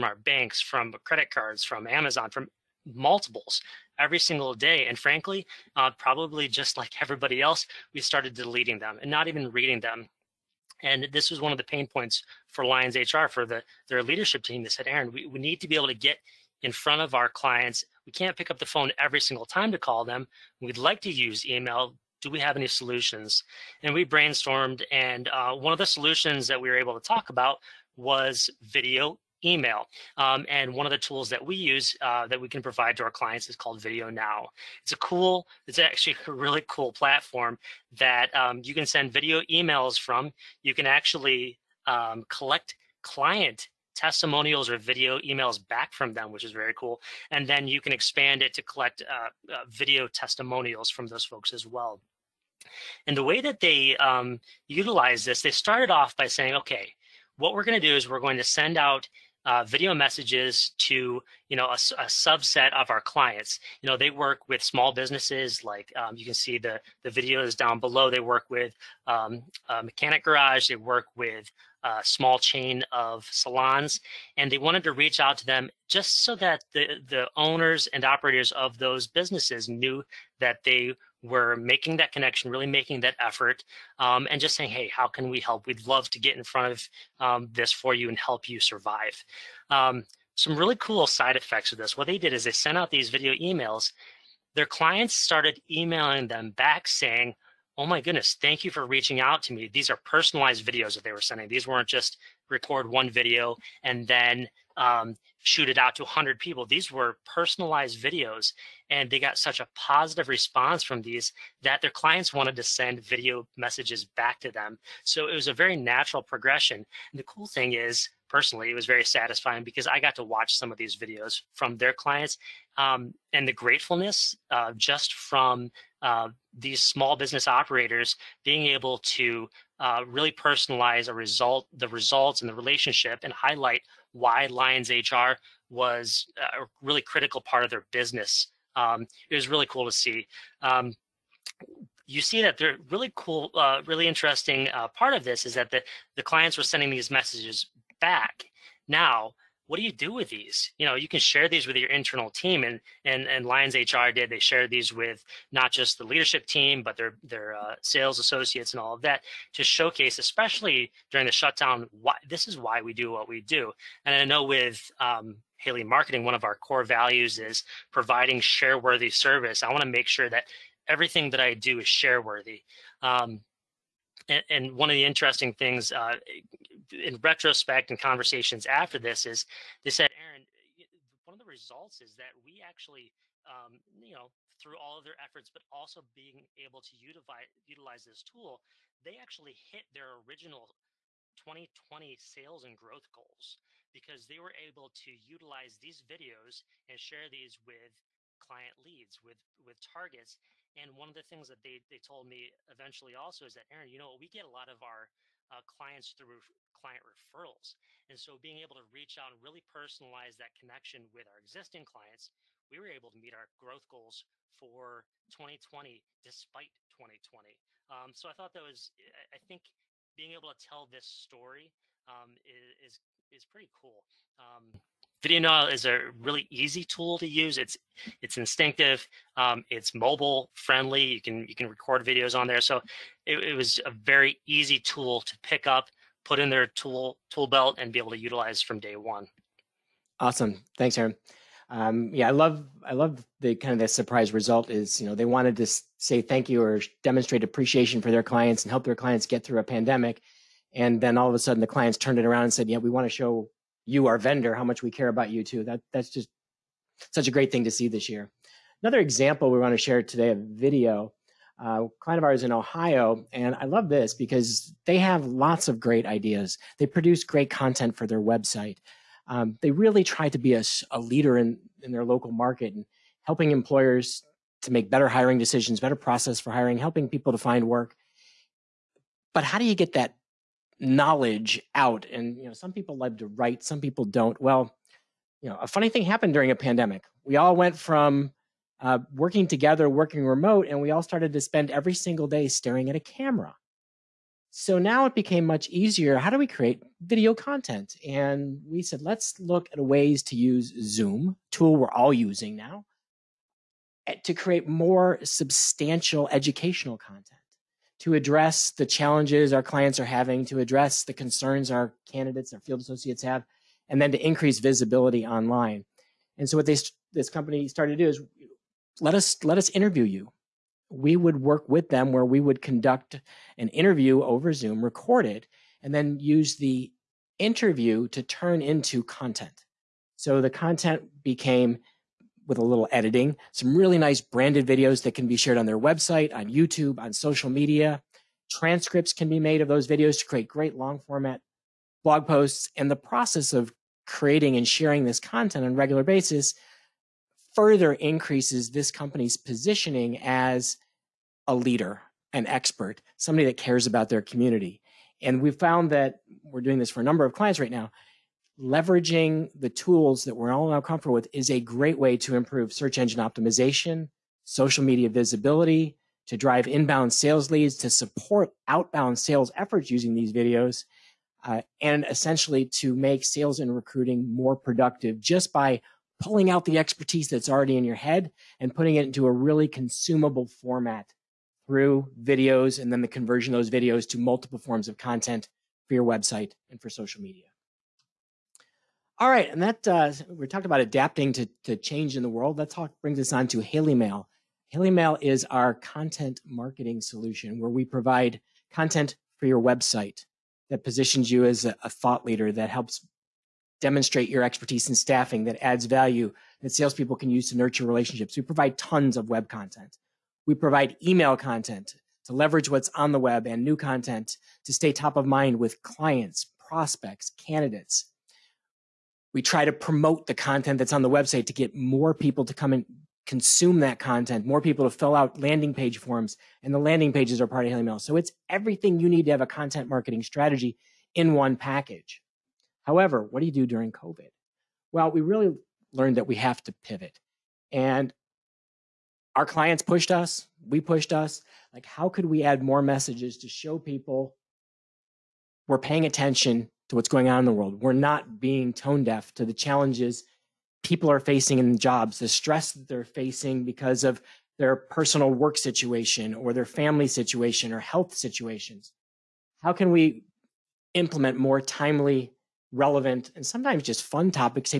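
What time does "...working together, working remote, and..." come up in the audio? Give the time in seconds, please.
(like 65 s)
289 s.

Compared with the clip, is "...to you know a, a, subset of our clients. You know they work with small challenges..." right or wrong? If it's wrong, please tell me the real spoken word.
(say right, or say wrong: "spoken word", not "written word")
wrong: "businesses", not "challenges".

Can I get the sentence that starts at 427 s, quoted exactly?
So it's everything you need to have a content marketing strategy in one package.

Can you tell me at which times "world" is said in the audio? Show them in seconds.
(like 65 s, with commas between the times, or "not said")
392 s, 447 s.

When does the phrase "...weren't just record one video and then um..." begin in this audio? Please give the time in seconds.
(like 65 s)
101 s.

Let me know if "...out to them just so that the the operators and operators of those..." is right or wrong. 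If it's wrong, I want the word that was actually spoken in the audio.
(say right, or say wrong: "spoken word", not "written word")
wrong: "owners", not "operators".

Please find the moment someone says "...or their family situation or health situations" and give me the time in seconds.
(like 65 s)
456 s.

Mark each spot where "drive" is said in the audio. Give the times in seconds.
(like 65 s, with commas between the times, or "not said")
366 s.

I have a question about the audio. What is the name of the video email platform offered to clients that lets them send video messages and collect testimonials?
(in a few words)
Video Now.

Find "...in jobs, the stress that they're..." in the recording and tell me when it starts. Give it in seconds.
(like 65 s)
451 s.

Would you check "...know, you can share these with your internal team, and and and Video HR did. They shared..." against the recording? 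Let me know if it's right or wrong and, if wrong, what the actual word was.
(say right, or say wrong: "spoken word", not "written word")
wrong: "Lyons", not "Video".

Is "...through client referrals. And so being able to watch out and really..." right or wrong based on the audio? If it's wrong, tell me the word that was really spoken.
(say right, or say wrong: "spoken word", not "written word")
wrong: "reach", not "watch".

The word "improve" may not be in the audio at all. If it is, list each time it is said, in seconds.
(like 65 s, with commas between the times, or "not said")
362 s.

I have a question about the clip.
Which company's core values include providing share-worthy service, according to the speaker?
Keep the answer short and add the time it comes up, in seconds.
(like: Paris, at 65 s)
Haley Marketing, at 165 s.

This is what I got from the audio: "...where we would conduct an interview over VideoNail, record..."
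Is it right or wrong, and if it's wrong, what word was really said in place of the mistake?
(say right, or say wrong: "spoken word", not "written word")
wrong: "Zoom", not "VideoNail".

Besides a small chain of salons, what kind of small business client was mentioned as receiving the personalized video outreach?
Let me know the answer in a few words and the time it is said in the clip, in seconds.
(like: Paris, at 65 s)
Mechanic garage, at 69 s.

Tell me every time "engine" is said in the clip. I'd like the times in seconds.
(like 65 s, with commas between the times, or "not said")
362 s.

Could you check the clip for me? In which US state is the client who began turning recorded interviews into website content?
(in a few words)
Ohio.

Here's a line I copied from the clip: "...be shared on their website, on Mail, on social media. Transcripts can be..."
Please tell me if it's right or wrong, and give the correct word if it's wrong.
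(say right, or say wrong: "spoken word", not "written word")
wrong: "YouTube", not "Mail".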